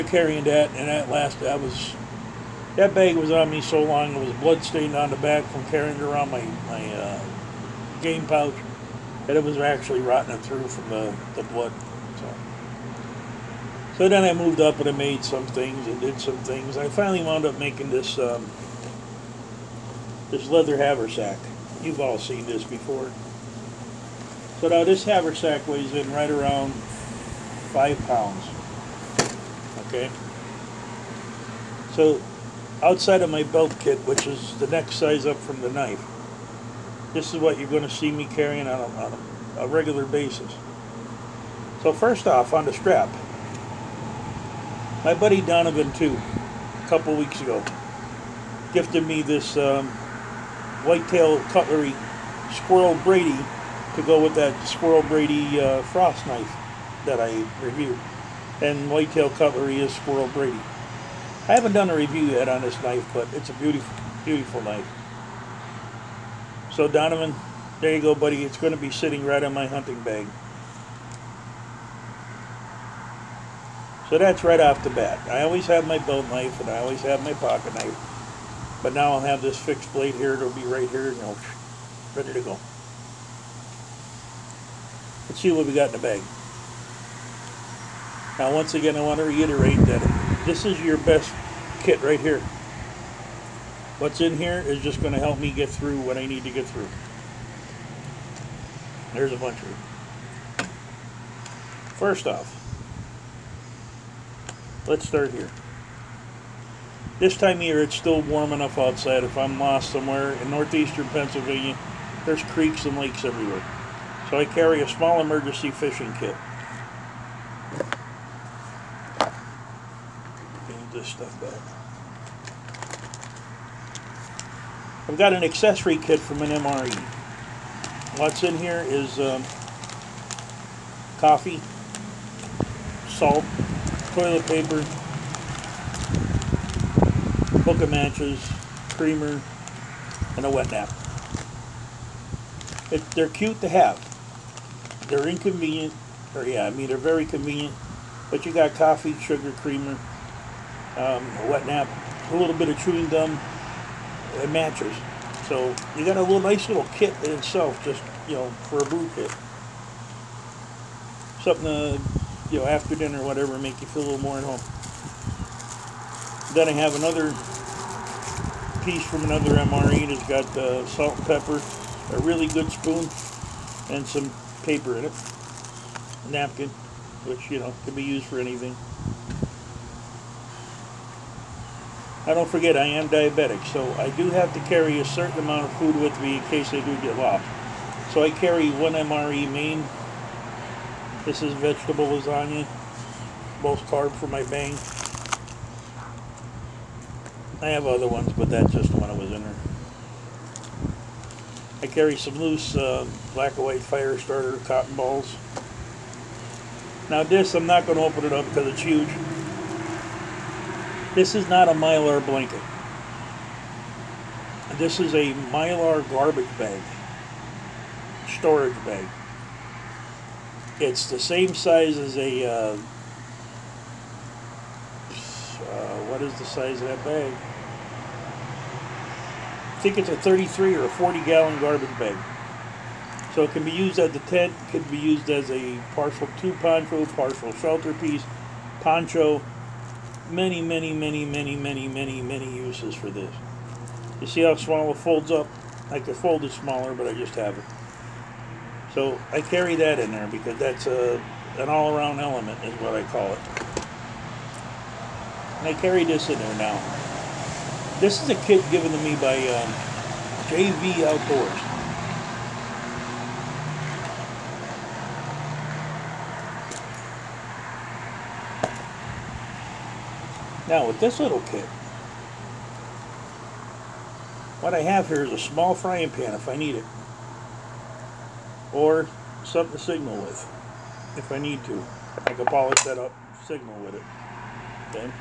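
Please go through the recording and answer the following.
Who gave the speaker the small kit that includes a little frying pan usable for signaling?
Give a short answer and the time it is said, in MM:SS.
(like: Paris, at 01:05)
JV Outdoors, at 04:20.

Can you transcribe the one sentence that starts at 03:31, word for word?
This is not a Mylar blanket.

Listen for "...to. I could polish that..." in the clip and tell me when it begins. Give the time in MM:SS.
04:41.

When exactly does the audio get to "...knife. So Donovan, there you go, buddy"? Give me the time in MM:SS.
01:04.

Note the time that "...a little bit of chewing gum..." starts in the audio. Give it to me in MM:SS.
02:32.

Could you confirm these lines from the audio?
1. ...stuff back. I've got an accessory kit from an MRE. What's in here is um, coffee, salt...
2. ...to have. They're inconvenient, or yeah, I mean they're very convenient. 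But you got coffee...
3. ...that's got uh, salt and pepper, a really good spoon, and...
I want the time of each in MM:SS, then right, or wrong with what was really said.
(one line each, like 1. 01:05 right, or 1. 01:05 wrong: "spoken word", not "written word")
1. 02:01 right
2. 02:23 right
3. 02:50 right.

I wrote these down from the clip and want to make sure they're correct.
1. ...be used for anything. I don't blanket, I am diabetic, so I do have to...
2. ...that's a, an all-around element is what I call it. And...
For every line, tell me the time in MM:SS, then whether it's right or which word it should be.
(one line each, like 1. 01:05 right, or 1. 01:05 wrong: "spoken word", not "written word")
1. 02:57 wrong: "forget", not "blanket"
2. 04:10 right.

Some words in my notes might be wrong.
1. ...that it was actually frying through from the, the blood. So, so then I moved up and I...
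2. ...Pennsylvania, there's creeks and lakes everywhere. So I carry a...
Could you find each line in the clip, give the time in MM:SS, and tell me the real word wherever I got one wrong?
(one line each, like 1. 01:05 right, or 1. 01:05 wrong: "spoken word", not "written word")
1. 00:09 wrong: "rotting", not "frying"
2. 01:51 right.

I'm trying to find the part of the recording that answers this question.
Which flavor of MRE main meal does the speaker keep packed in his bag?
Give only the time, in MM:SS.
03:11.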